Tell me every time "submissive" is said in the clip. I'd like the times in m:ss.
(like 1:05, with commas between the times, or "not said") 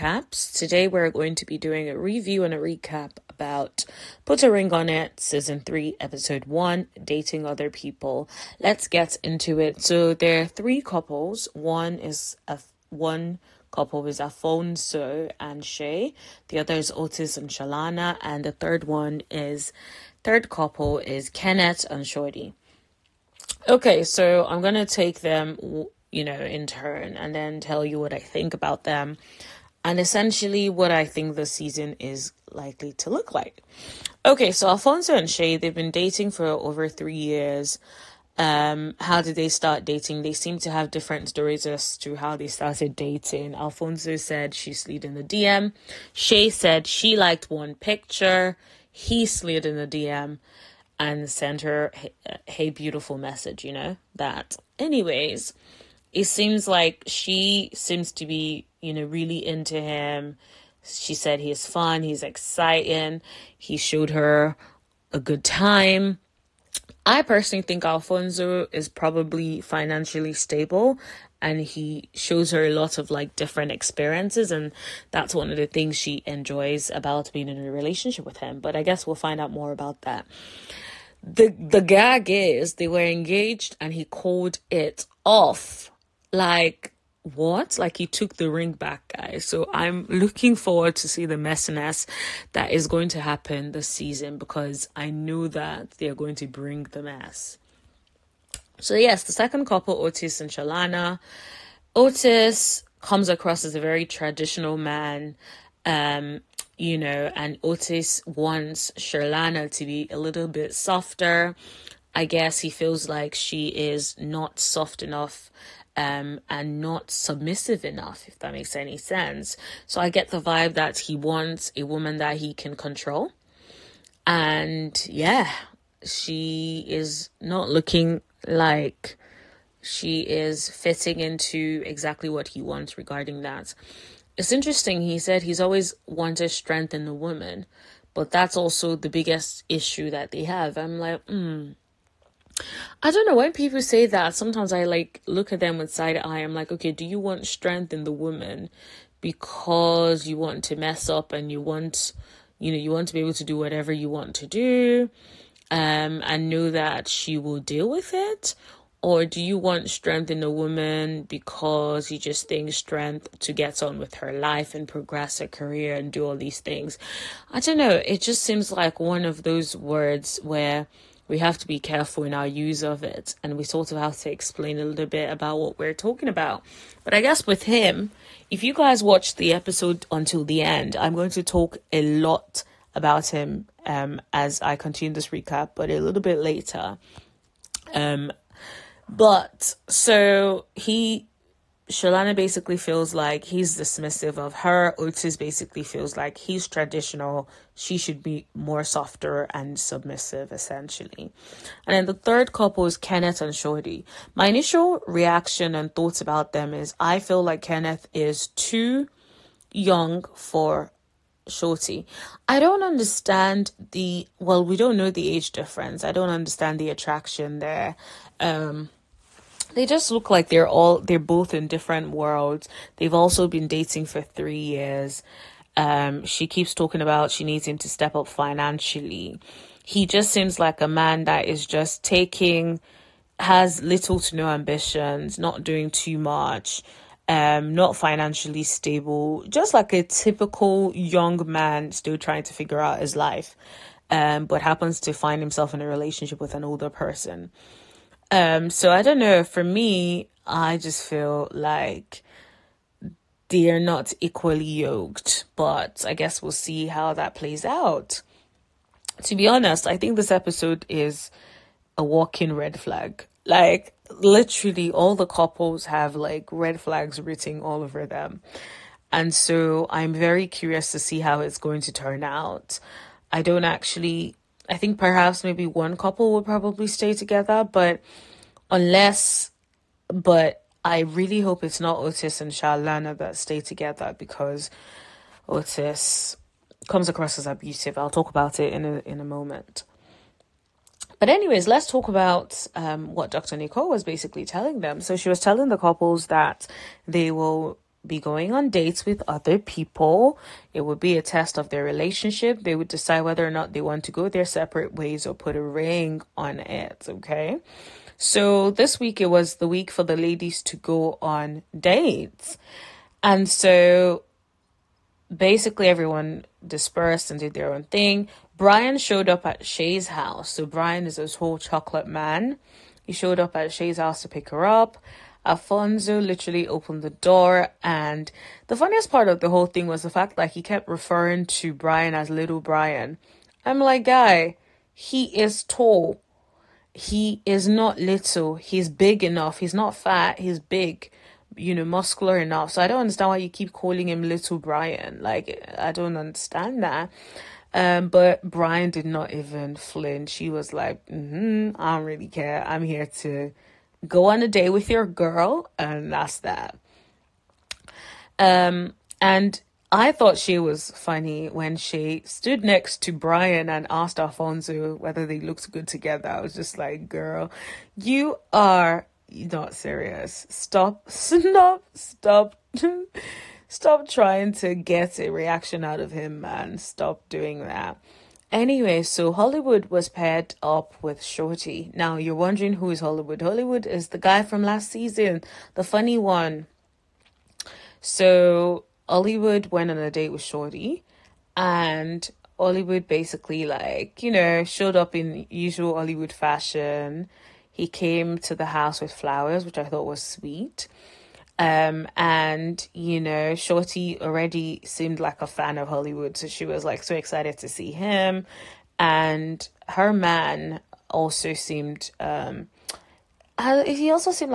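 1:57, 3:19.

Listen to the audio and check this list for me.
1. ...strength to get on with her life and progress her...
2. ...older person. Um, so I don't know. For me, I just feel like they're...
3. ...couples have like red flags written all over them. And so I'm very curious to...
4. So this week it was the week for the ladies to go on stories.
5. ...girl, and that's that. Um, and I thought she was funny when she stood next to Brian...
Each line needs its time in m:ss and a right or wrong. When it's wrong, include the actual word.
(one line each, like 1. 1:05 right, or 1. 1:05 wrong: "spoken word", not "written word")
1. 2:42 right
2. 4:06 right
3. 4:25 right
4. 5:08 wrong: "dates", not "stories"
5. 5:55 right.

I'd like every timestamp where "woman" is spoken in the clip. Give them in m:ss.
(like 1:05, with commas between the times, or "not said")
2:01, 2:17, 2:28, 2:40.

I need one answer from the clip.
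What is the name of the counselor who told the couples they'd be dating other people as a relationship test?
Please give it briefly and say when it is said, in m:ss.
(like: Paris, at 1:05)
Dr. Nicole, at 4:53.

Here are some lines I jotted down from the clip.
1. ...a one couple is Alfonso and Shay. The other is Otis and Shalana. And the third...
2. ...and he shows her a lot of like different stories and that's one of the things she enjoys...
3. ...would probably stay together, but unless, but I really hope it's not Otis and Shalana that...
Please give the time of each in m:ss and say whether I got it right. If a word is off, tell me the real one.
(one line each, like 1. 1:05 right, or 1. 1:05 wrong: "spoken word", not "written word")
1. 0:12 right
2. 1:11 wrong: "experiences", not "stories"
3. 4:36 right.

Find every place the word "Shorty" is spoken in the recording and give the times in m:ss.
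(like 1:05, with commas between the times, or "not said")
0:22, 3:23, 3:31, 6:21, 6:30, 6:43.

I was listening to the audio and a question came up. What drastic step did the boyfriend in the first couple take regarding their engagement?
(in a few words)
Took the ring back.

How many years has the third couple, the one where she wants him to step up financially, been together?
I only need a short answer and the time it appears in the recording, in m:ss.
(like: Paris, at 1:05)
3, at 3:44.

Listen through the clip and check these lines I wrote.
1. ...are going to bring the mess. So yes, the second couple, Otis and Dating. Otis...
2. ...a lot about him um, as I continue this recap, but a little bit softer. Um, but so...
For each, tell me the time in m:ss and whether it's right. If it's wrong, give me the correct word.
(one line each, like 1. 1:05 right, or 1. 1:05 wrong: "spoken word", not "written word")
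1. 1:36 wrong: "Shalana", not "Dating"
2. 3:01 wrong: "later", not "softer".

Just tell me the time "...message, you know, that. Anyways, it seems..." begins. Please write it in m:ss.
0:53.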